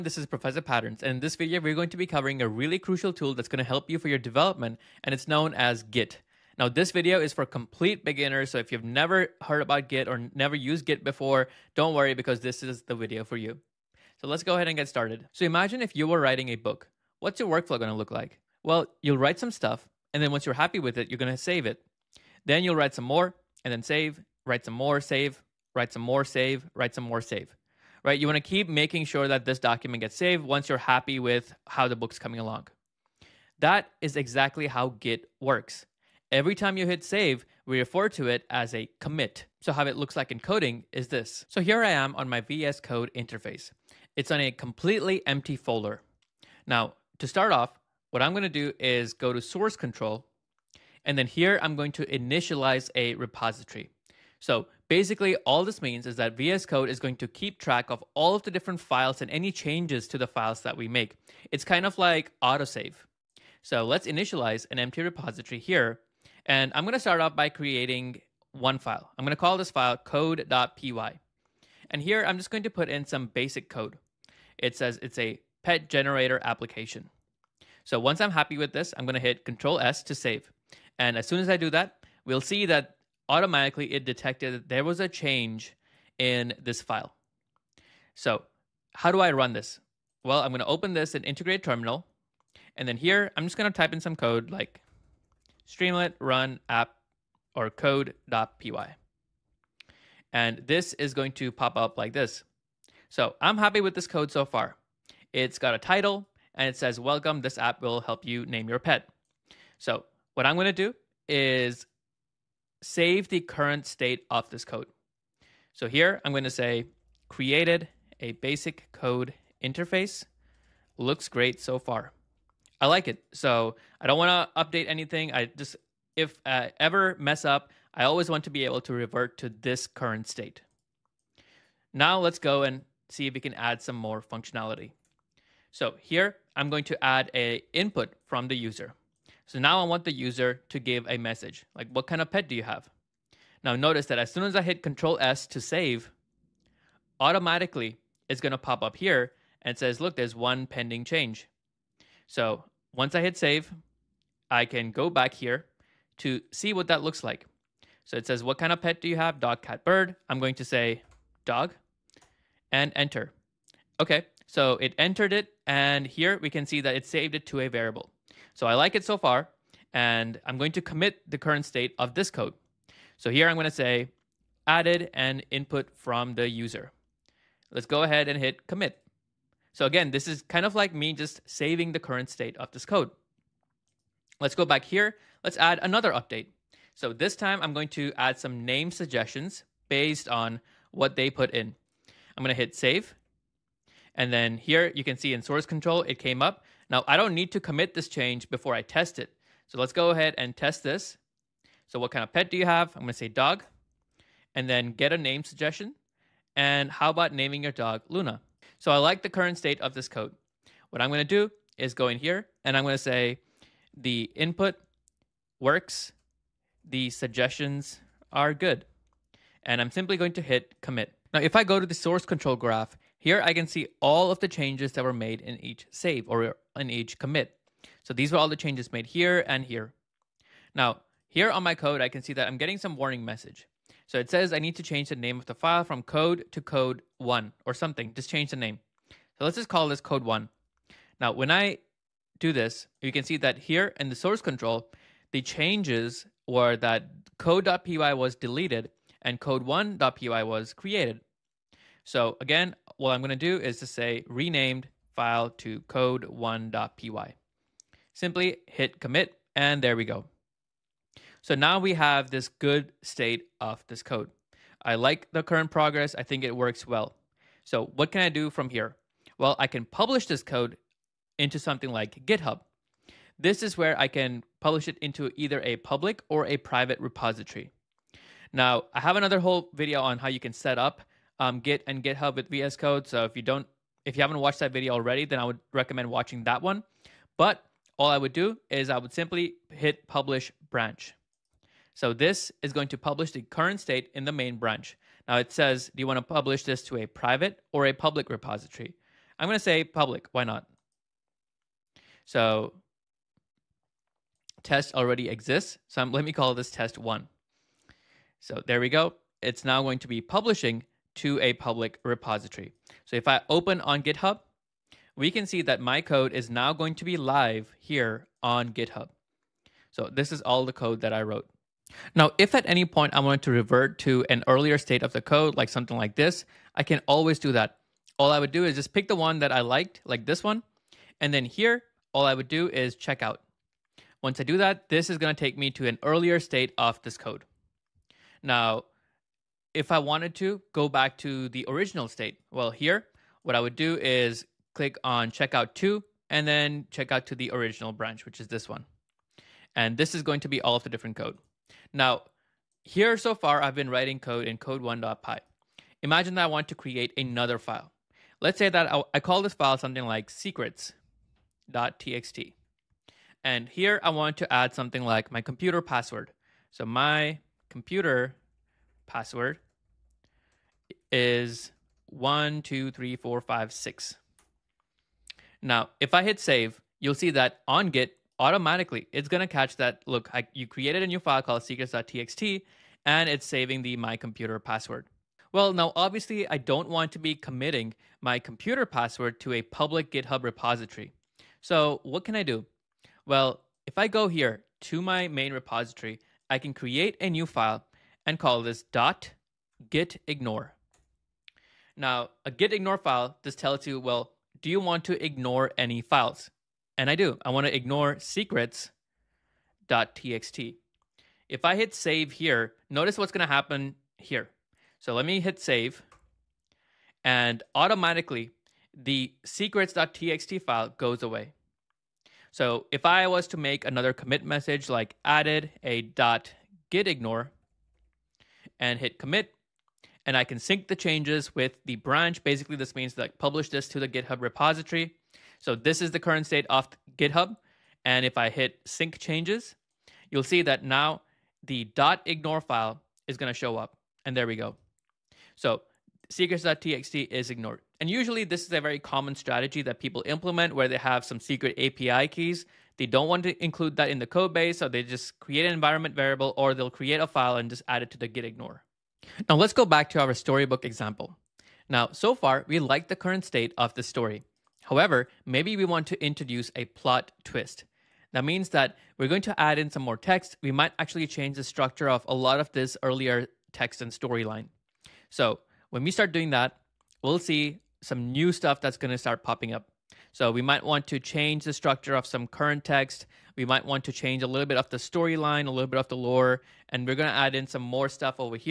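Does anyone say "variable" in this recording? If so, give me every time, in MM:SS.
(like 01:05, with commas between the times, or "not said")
02:47, 07:36.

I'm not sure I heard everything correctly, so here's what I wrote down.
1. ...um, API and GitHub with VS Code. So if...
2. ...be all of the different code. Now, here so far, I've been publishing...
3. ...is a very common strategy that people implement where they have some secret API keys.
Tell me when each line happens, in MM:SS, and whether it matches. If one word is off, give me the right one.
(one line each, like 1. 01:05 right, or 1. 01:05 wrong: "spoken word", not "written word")
1. 04:41 wrong: "Git", not "API"
2. 05:50 wrong: "writing", not "publishing"
3. 07:28 right.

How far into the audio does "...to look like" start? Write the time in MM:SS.
00:17.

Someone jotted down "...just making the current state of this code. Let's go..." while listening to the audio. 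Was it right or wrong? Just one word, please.
wrong.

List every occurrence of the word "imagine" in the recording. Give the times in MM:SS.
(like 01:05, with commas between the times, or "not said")
00:15, 05:56.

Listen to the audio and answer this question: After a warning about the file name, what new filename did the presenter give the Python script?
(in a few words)
code1.py.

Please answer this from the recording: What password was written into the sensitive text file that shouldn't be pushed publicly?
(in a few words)
123456.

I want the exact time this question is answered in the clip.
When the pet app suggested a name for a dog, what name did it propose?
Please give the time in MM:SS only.
03:28.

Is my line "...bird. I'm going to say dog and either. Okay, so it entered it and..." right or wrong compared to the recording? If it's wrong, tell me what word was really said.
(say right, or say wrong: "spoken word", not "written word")
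wrong: "enter", not "either".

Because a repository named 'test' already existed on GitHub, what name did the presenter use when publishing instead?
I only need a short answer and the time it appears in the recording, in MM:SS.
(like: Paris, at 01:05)
test one, at 05:06.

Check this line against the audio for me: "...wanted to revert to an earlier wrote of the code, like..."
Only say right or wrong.
wrong.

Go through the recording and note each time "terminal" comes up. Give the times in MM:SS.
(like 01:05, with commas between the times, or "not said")
01:31.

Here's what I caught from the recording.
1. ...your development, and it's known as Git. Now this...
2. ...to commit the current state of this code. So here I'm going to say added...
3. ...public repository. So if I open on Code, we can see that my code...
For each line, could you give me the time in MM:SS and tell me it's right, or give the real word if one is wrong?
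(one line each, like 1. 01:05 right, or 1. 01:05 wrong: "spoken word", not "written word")
1. 00:04 right
2. 02:50 right
3. 05:11 wrong: "GitHub", not "Code".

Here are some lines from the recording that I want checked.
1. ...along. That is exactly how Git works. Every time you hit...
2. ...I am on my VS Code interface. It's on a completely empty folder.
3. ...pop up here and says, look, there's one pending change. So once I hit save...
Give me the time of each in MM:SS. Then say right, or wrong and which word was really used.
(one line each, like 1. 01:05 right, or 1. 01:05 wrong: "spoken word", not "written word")
1. 00:32 right
2. 00:41 right
3. 02:28 right.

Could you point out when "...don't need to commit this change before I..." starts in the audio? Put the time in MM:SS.
03:17.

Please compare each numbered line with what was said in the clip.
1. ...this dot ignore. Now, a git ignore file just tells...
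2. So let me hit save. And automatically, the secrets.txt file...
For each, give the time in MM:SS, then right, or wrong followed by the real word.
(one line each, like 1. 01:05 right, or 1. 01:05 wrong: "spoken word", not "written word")
1. 06:38 wrong: "gitignore", not "ignore"
2. 06:54 right.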